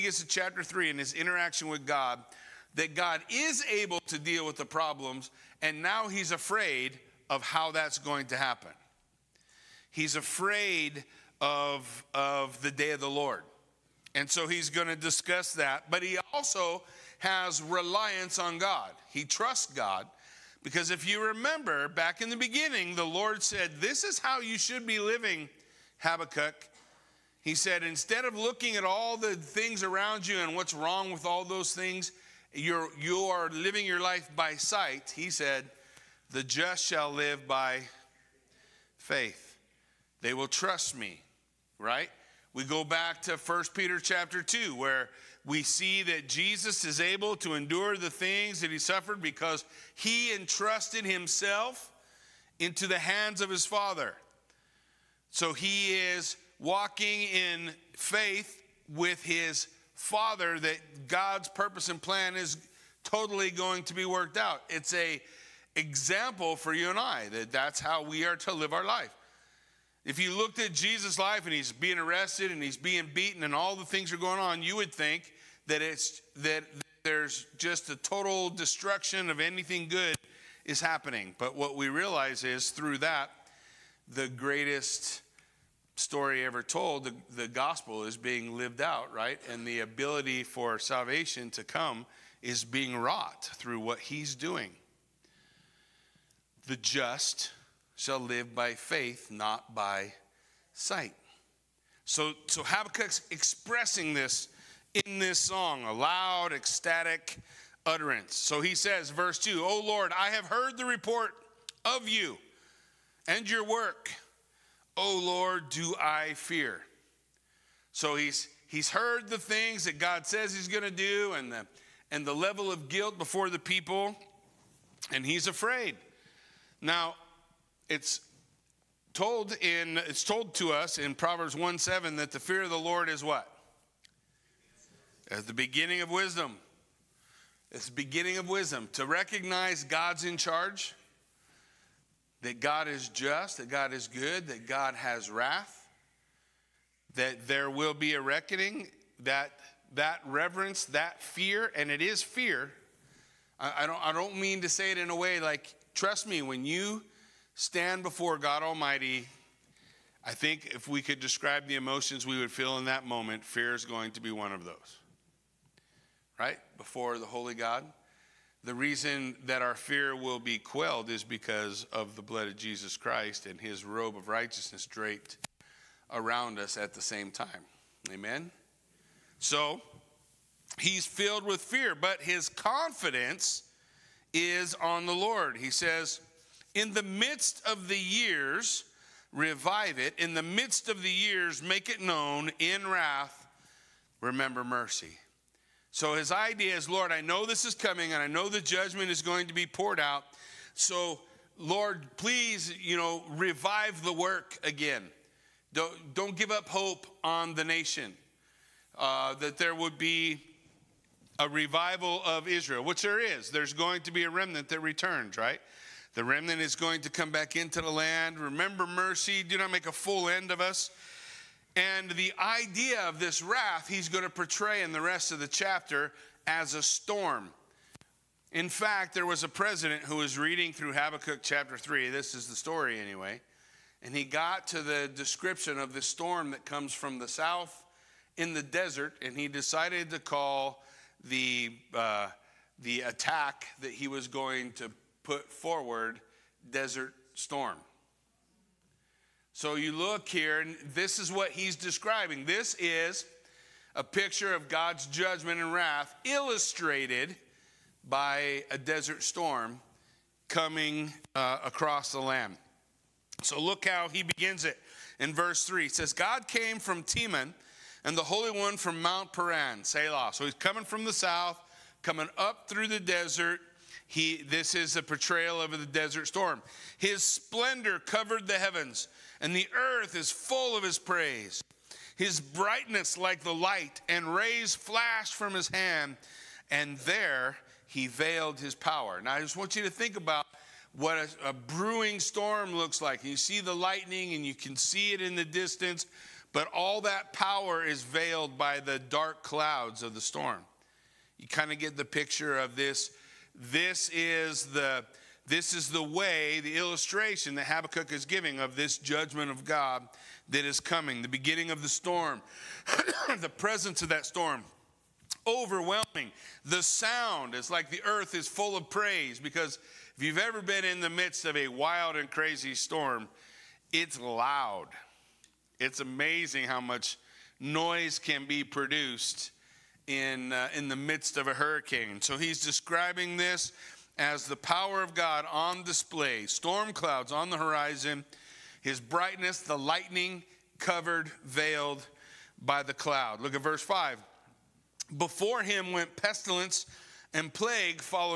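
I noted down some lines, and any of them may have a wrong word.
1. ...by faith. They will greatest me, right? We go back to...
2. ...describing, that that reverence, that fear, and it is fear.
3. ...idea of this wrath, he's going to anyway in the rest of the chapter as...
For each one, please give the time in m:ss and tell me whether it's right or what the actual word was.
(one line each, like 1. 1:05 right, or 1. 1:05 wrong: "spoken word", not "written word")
1. 0:37 wrong: "trust", not "greatest"
2. 2:28 wrong: "reckoning", not "describing"
3. 3:42 wrong: "portray", not "anyway".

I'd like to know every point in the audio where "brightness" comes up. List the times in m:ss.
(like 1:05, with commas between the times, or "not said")
4:42, 5:38.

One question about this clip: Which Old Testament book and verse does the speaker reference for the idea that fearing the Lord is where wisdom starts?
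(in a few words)
Proverbs 1:7.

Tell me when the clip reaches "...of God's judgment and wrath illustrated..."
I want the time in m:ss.
4:14.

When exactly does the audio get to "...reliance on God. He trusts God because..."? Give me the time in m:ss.
0:17.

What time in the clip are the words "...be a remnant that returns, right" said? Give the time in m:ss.
3:34.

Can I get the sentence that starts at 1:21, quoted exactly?
But what we realize is through that, the greatest story ever told, the, the gospel is being lived out, right?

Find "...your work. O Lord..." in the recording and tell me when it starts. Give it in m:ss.
1:53.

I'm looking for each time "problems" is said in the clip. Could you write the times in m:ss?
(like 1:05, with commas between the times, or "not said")
0:04.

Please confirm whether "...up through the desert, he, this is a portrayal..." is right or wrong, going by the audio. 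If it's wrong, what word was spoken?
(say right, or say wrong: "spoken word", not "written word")
right.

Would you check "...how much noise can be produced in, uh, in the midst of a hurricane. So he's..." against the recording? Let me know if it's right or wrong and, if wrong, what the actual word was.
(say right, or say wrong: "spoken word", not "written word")
right.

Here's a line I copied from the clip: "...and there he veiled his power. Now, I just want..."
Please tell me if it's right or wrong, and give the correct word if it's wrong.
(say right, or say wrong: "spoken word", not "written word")
right.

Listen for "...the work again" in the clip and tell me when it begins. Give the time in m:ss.
3:24.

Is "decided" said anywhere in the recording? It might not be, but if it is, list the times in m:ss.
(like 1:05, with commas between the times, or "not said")
3:59.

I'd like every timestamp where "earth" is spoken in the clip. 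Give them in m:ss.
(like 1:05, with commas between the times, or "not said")
4:39, 5:18.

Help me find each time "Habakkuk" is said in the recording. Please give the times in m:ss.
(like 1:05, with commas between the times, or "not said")
0:25, 1:42, 3:50, 5:07.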